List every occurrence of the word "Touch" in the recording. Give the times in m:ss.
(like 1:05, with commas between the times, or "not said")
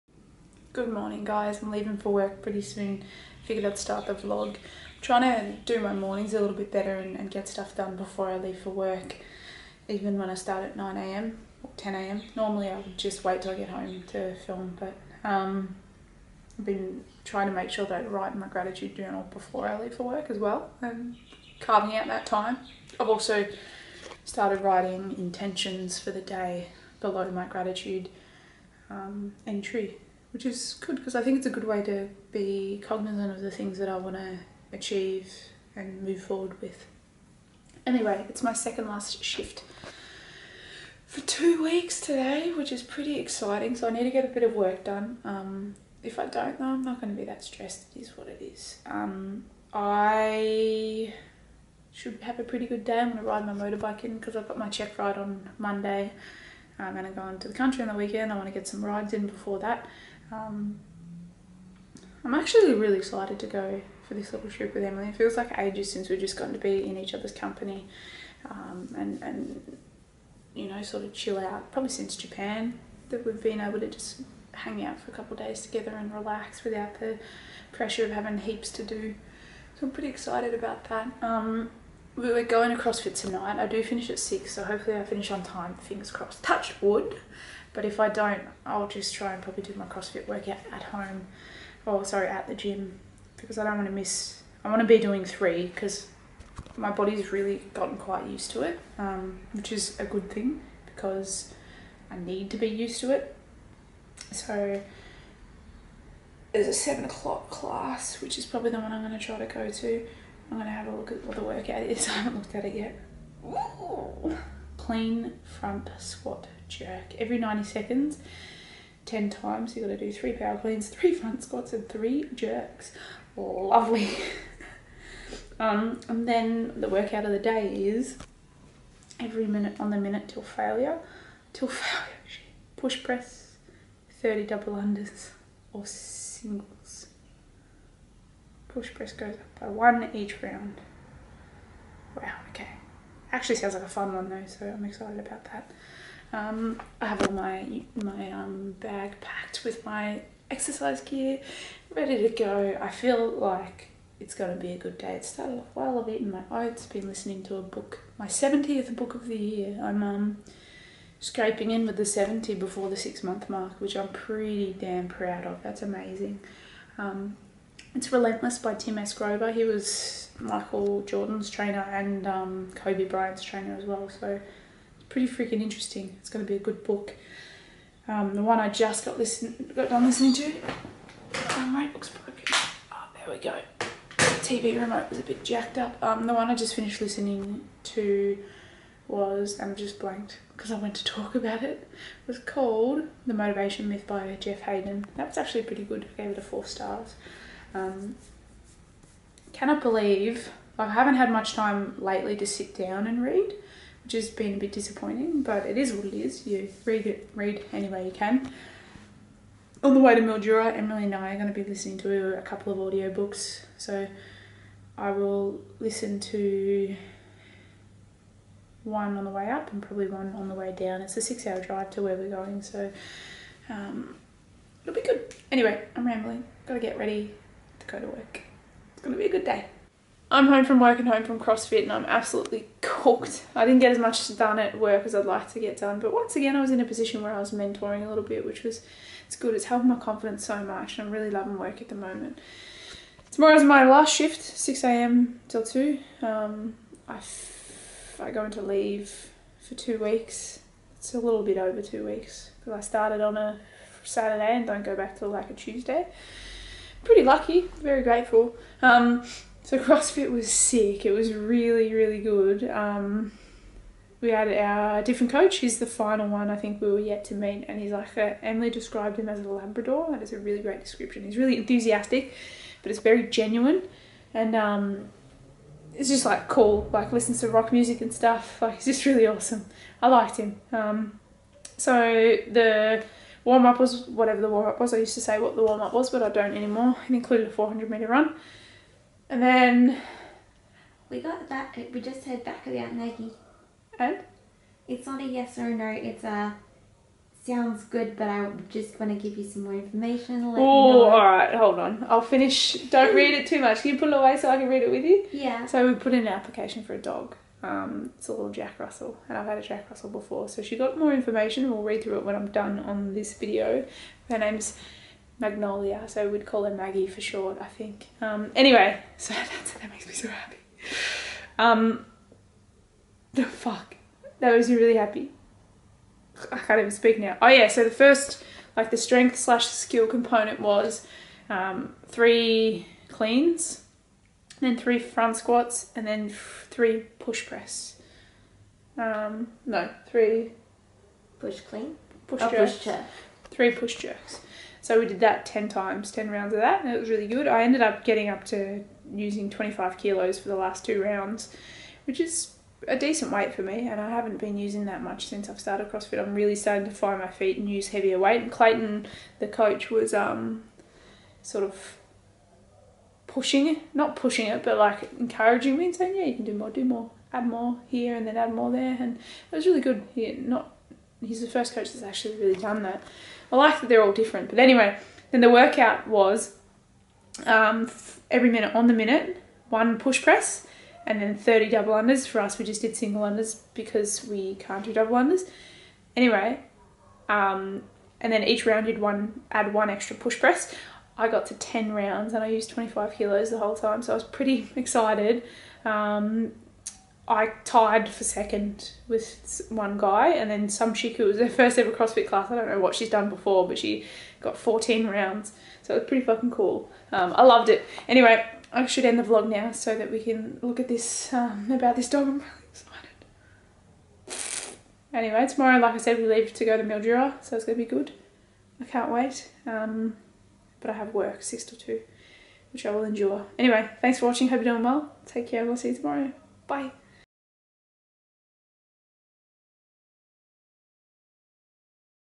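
1:26.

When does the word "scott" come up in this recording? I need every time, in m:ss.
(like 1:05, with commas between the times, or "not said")
not said.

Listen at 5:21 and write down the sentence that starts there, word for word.
Um, the fuck, that makes me really happy.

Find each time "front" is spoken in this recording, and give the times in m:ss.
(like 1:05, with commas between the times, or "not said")
1:55, 2:01, 5:34.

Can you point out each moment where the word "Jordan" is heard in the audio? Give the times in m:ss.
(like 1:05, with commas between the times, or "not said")
2:51.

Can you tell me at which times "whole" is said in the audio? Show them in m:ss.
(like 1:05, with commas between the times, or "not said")
6:33.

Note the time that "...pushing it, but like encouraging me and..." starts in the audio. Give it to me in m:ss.
6:04.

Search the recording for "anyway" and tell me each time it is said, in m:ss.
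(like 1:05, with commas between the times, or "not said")
0:37, 3:45, 5:18, 6:14, 6:26, 6:48, 6:55, 7:03.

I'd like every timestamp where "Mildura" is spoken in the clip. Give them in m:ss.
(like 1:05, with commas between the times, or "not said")
3:30, 6:56.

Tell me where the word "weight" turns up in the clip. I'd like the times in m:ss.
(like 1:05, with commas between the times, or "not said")
5:53, 5:58.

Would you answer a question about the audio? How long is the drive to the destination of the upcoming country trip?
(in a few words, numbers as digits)
6 hours.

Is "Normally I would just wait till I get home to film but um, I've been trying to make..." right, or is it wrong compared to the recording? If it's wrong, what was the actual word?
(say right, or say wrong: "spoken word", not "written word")
right.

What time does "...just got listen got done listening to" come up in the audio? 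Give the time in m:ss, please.
2:58.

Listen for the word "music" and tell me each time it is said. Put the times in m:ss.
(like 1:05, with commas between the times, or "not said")
4:37.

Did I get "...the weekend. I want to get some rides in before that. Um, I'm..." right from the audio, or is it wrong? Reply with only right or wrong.
right.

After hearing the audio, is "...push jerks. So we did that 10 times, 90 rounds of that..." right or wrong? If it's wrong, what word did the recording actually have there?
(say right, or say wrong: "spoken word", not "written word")
wrong: "10", not "90".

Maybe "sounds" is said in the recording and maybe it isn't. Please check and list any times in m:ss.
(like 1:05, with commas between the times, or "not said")
2:23, 4:57.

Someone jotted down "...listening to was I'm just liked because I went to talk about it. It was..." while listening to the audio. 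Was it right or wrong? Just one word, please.
wrong.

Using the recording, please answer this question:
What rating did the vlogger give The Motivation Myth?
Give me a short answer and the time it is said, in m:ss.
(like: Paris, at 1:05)
4 stars, at 3:16.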